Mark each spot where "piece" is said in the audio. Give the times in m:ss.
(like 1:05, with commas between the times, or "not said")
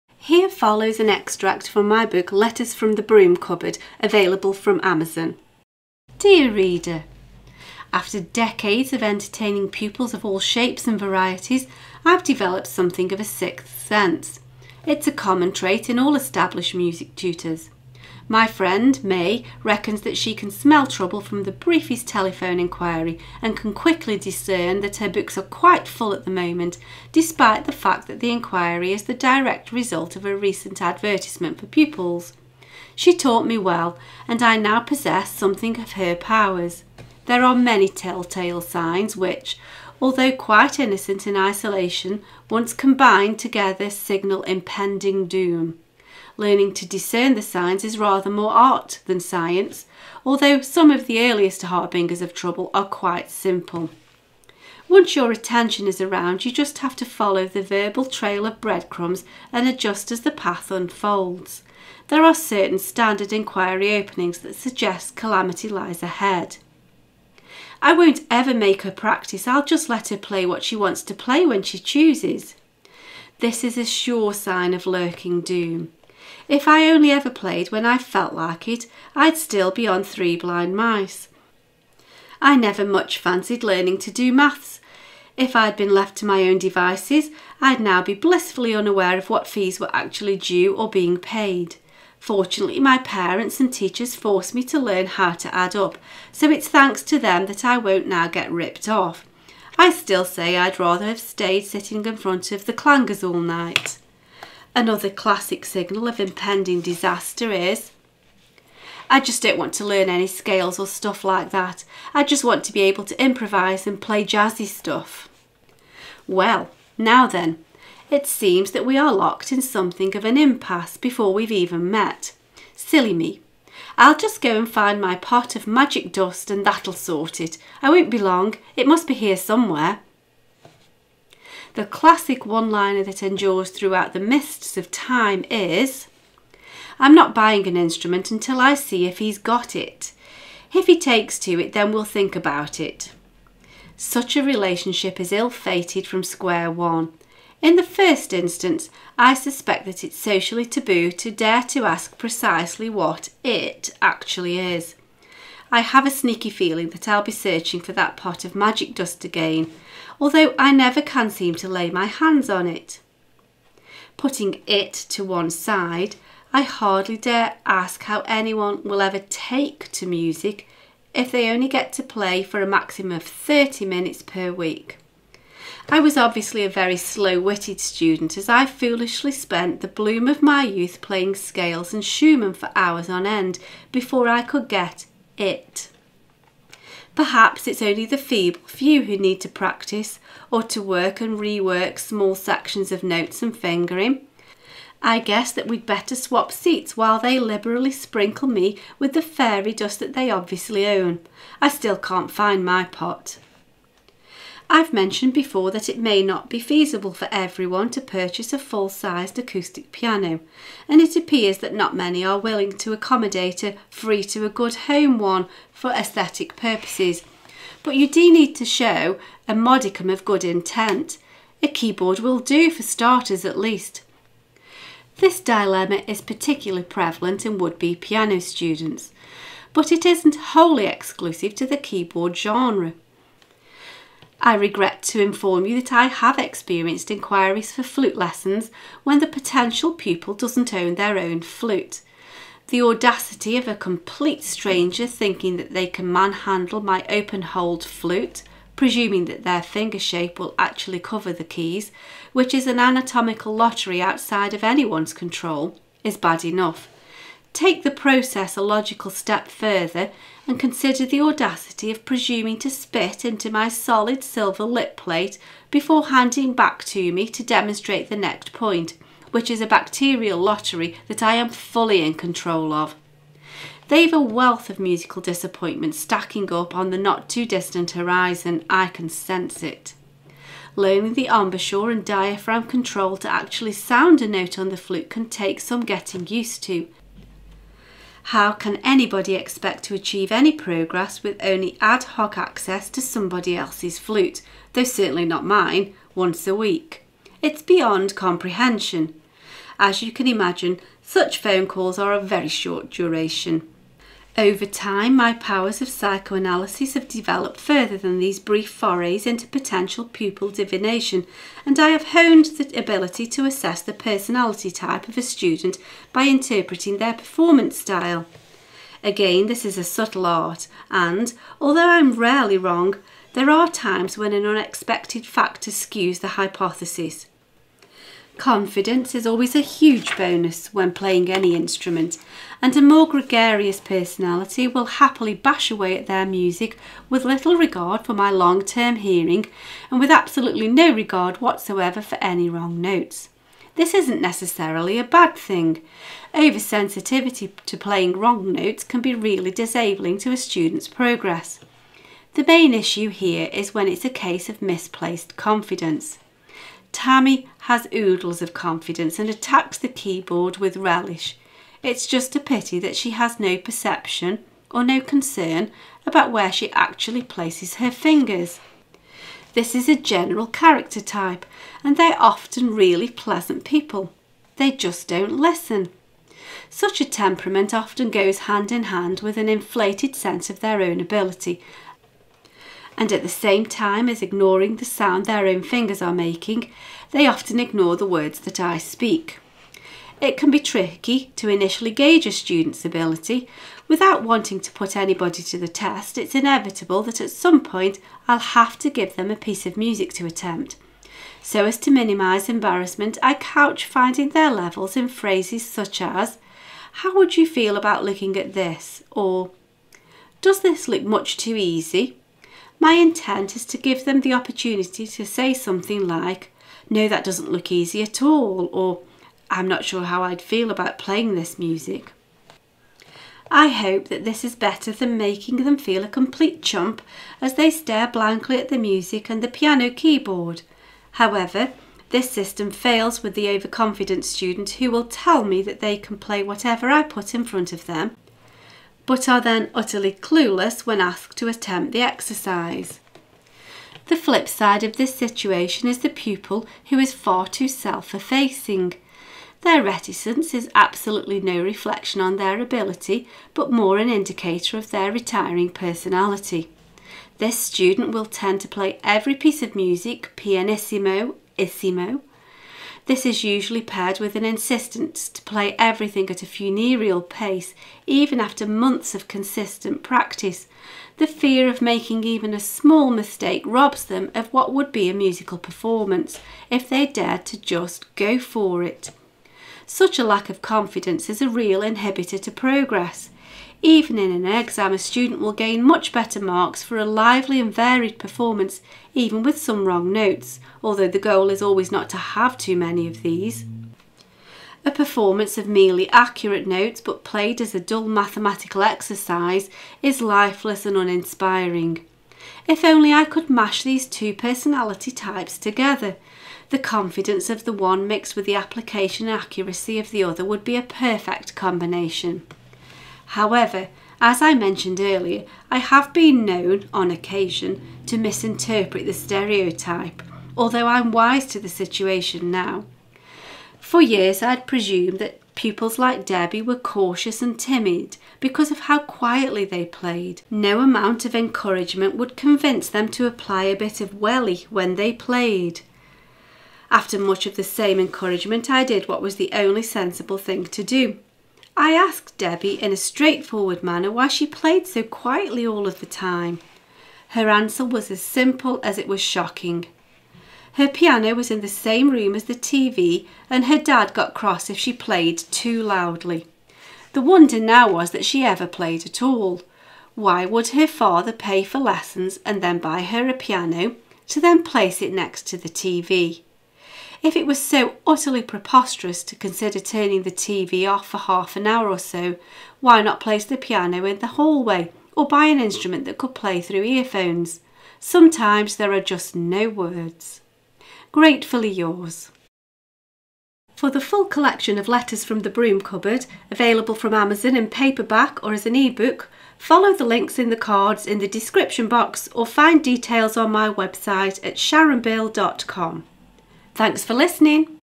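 6:39, 7:39.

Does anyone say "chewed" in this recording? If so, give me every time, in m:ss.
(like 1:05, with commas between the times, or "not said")
not said.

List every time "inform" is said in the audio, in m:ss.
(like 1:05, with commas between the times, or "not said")
3:55.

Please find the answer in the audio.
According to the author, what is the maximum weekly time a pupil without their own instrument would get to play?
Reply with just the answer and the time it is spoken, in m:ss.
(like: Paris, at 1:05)
30 minutes, at 2:53.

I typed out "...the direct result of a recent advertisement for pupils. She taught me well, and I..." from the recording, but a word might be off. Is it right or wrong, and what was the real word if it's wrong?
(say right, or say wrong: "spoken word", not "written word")
right.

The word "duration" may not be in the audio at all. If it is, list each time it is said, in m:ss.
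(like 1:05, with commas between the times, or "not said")
5:02.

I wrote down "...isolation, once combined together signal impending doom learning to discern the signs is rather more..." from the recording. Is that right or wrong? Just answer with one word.
right.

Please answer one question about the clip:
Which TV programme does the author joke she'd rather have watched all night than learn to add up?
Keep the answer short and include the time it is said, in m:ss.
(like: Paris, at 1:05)
The Clangers, at 1:42.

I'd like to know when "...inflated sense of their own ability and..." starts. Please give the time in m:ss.
6:19.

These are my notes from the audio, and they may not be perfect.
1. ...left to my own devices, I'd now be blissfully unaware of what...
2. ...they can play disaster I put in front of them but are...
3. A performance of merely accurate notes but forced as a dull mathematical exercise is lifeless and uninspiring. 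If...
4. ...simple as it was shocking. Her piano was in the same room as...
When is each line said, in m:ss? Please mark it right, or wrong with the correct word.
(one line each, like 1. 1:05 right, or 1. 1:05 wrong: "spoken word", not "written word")
1. 1:25 right
2. 7:15 wrong: "whatever", not "disaster"
3. 8:14 wrong: "played", not "forced"
4. 9:08 right.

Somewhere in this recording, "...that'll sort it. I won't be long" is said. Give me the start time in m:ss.
2:06.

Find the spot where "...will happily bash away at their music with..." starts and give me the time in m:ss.
5:34.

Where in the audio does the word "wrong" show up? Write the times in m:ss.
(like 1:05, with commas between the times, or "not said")
5:22, 5:42, 5:48, 8:09.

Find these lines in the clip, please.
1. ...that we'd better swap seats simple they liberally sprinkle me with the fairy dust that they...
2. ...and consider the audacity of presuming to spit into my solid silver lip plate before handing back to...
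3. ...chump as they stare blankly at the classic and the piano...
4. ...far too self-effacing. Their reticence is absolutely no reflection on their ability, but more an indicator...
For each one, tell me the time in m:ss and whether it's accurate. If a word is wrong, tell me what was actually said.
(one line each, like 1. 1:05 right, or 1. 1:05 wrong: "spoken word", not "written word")
1. 3:15 wrong: "while", not "simple"
2. 4:20 right
3. 7:06 wrong: "music", not "classic"
4. 7:27 right.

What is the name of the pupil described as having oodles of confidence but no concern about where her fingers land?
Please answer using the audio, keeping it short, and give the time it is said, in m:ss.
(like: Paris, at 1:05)
Tammy, at 5:56.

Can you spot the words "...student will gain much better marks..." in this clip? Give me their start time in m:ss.
8:04.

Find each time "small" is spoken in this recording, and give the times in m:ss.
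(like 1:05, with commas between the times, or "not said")
3:11, 7:52.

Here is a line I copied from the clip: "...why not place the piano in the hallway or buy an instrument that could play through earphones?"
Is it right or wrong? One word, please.
right.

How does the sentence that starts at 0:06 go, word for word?
Dear reader, after decades of entertaining pupils of all shapes and varieties, I've developed something of a sixth sense.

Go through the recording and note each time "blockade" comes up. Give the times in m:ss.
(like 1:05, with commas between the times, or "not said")
not said.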